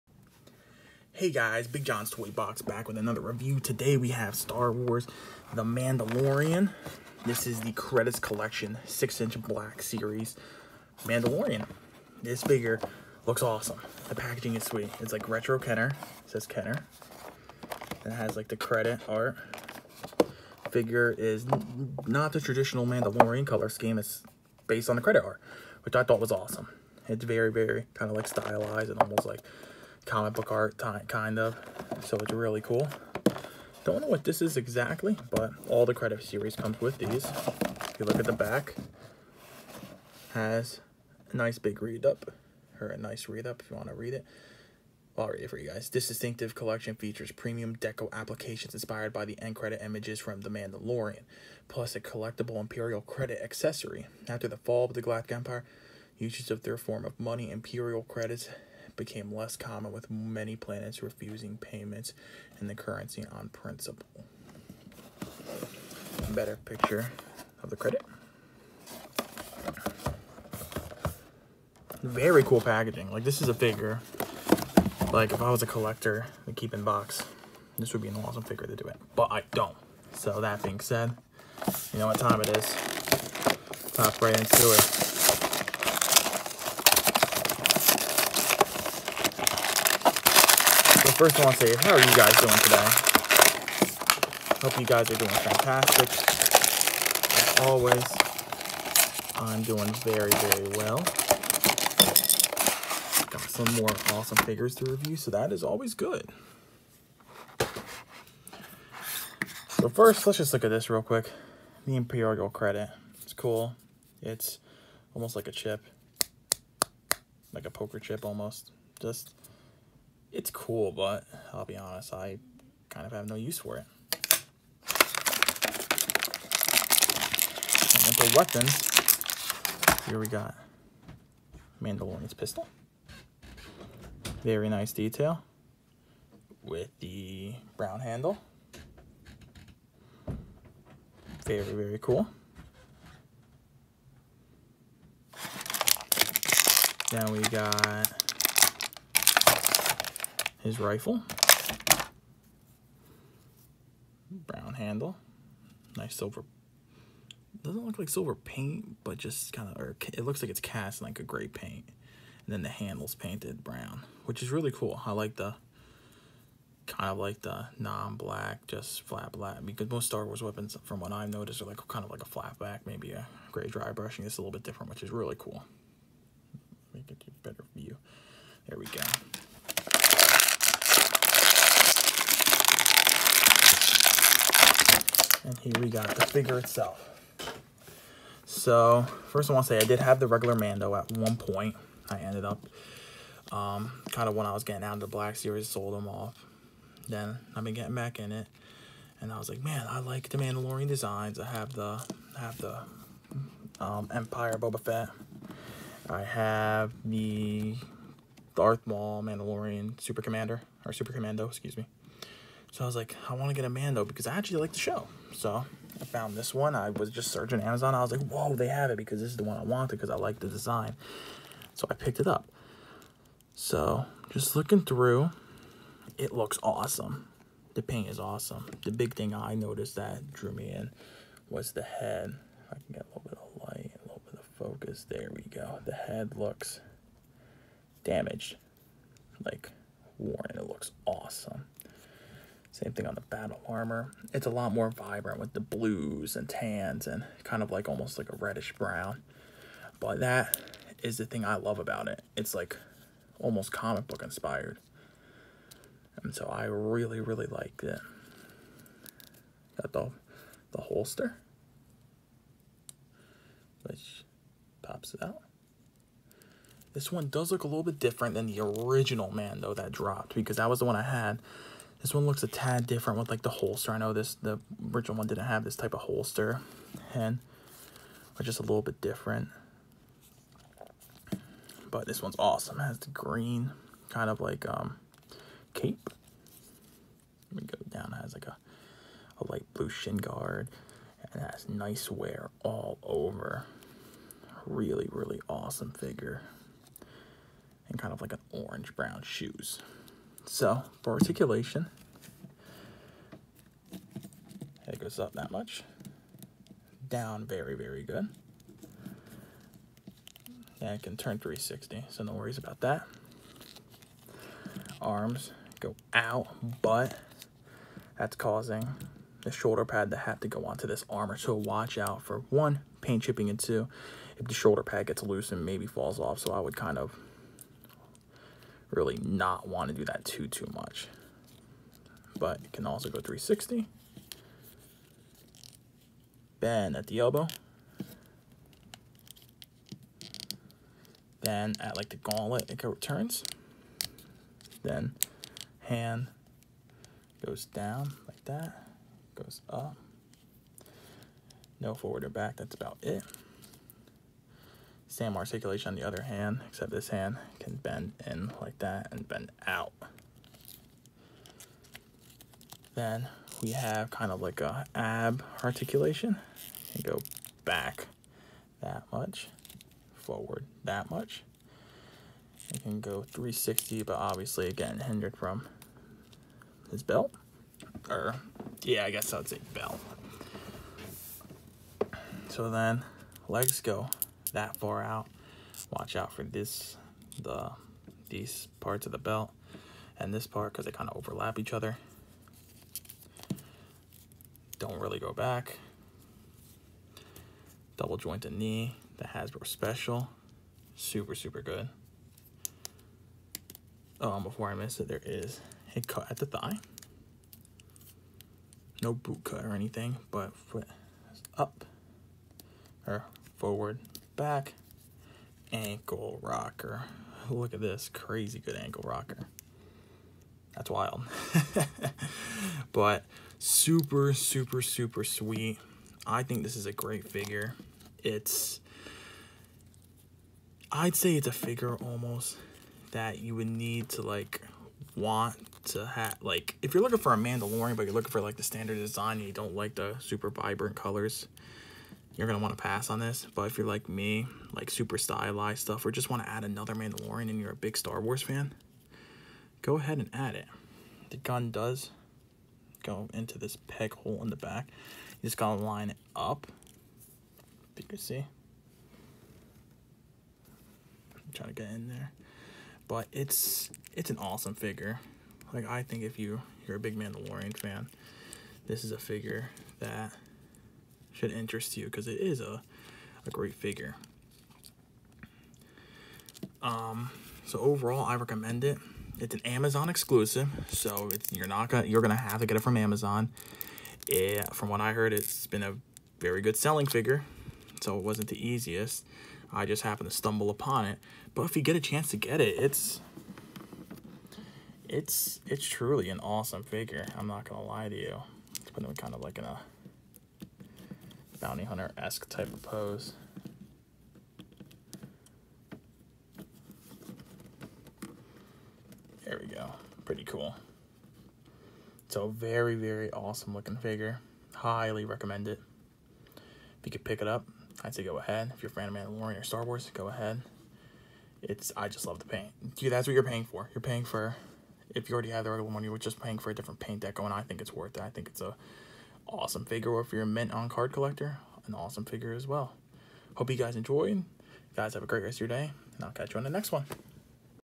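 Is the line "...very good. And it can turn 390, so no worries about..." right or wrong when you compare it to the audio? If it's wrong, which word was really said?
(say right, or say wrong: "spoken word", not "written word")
wrong: "360", not "390".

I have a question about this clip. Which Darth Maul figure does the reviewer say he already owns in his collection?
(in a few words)
Super Commando.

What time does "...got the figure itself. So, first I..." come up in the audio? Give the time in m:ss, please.
3:05.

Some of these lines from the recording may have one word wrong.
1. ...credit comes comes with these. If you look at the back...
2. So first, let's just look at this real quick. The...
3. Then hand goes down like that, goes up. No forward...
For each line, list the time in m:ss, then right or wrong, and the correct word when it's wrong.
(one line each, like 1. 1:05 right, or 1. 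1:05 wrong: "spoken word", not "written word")
1. 0:35 wrong: "series", not "comes"
2. 1:49 right
3. 5:44 right.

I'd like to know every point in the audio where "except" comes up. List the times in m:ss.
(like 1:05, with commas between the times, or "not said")
5:56.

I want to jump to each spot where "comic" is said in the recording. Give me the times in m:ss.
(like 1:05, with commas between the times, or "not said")
0:30, 4:13.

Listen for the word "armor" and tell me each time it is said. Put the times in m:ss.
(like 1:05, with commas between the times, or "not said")
4:03, 5:21.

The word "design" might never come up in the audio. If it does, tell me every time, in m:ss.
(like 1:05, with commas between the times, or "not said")
3:20, 3:40, 7:18.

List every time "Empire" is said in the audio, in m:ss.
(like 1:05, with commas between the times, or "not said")
0:55, 3:24.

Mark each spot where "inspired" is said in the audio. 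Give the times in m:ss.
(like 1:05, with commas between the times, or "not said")
0:48, 4:14.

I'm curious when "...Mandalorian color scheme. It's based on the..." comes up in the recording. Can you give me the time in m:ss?
0:22.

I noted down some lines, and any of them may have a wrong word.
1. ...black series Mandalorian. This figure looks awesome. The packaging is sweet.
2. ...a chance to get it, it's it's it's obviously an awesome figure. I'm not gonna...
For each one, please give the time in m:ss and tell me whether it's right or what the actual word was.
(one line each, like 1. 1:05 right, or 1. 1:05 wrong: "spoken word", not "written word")
1. 0:09 right
2. 8:11 wrong: "truly", not "obviously".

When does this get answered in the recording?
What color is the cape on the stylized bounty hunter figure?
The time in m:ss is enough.
4:43.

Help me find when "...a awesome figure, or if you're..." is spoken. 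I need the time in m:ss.
8:48.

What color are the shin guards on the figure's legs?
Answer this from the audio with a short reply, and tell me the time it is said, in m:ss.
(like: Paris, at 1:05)
light blue, at 4:49.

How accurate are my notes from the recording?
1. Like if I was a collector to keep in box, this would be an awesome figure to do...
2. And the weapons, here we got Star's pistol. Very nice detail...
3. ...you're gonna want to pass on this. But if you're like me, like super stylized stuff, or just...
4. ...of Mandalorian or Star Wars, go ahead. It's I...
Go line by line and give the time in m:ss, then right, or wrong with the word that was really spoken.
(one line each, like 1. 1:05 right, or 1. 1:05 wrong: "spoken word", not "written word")
1. 1:15 right
2. 2:08 wrong: "Mandalorian", not "Star"
3. 7:22 right
4. 8:39 right.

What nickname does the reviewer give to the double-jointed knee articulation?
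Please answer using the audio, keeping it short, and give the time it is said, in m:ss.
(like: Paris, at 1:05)
the Hasbro Special, at 6:39.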